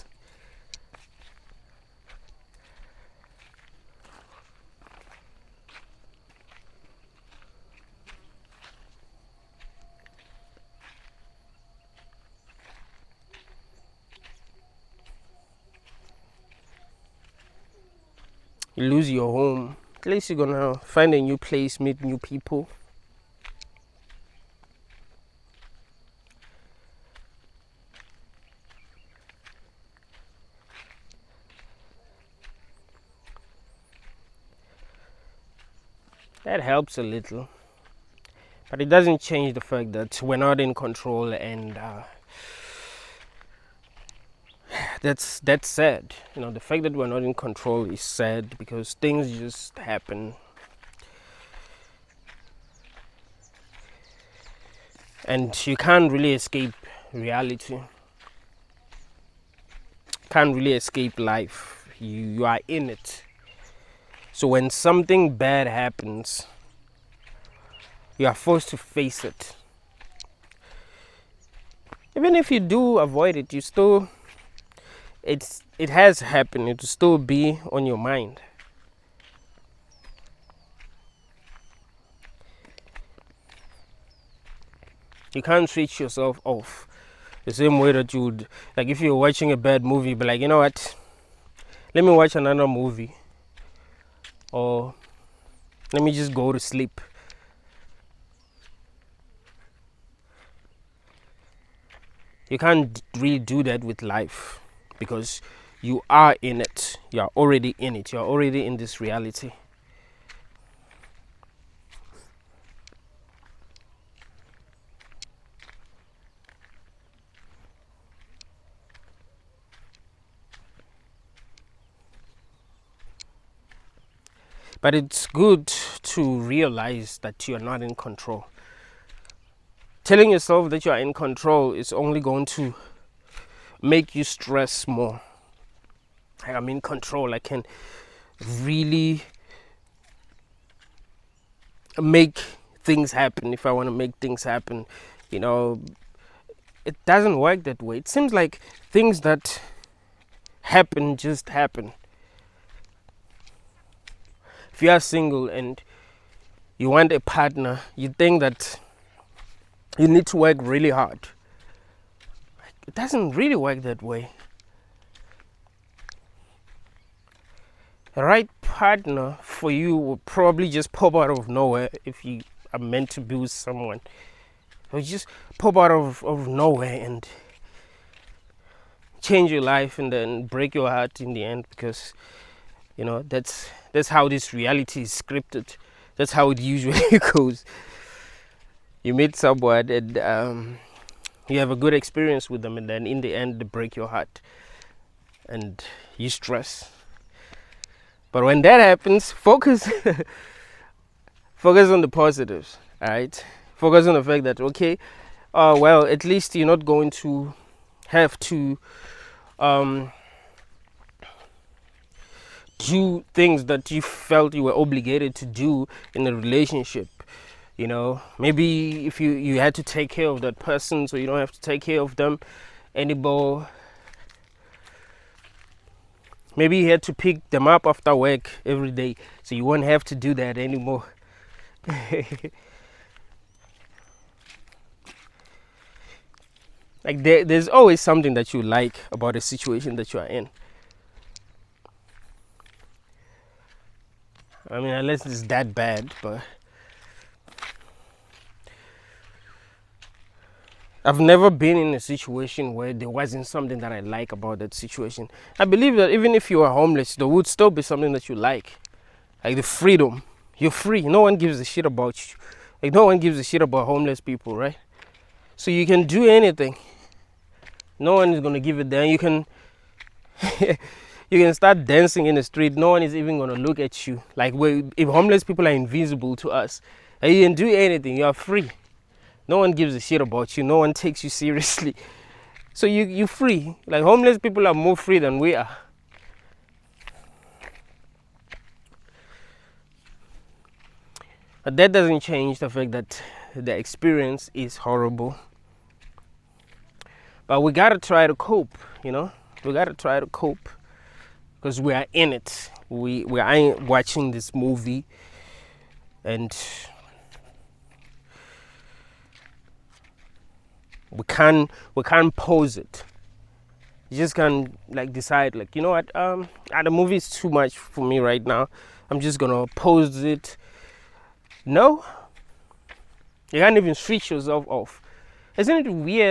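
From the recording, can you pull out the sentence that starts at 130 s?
Telling yourself that you are in control is only going to make you stress more.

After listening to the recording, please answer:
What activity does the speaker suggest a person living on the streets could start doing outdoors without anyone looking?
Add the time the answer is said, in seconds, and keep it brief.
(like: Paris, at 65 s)
dancing in the street, at 271 s.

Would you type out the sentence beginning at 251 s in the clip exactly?
I've never been in a situation where there wasn't something that I like about that situation.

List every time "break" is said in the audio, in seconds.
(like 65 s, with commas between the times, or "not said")
180 s, 193 s.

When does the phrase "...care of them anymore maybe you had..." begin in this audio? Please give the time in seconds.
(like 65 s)
221 s.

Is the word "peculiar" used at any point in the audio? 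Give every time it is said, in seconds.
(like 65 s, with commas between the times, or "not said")
not said.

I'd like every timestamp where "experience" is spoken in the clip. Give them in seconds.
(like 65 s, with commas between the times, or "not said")
191 s, 293 s.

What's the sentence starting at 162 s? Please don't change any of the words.
It doesn't really work that way.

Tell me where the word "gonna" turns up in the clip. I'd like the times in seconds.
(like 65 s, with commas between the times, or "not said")
20 s, 268 s, 319 s.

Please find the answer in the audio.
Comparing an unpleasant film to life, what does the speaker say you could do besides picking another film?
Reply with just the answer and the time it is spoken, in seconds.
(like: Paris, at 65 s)
go to sleep, at 96 s.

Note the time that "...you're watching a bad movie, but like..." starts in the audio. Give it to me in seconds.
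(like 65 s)
89 s.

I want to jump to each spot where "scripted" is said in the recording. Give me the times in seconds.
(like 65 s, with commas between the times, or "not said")
185 s.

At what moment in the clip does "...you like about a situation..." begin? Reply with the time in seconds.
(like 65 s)
238 s.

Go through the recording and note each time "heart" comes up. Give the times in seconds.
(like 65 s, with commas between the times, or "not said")
180 s, 194 s.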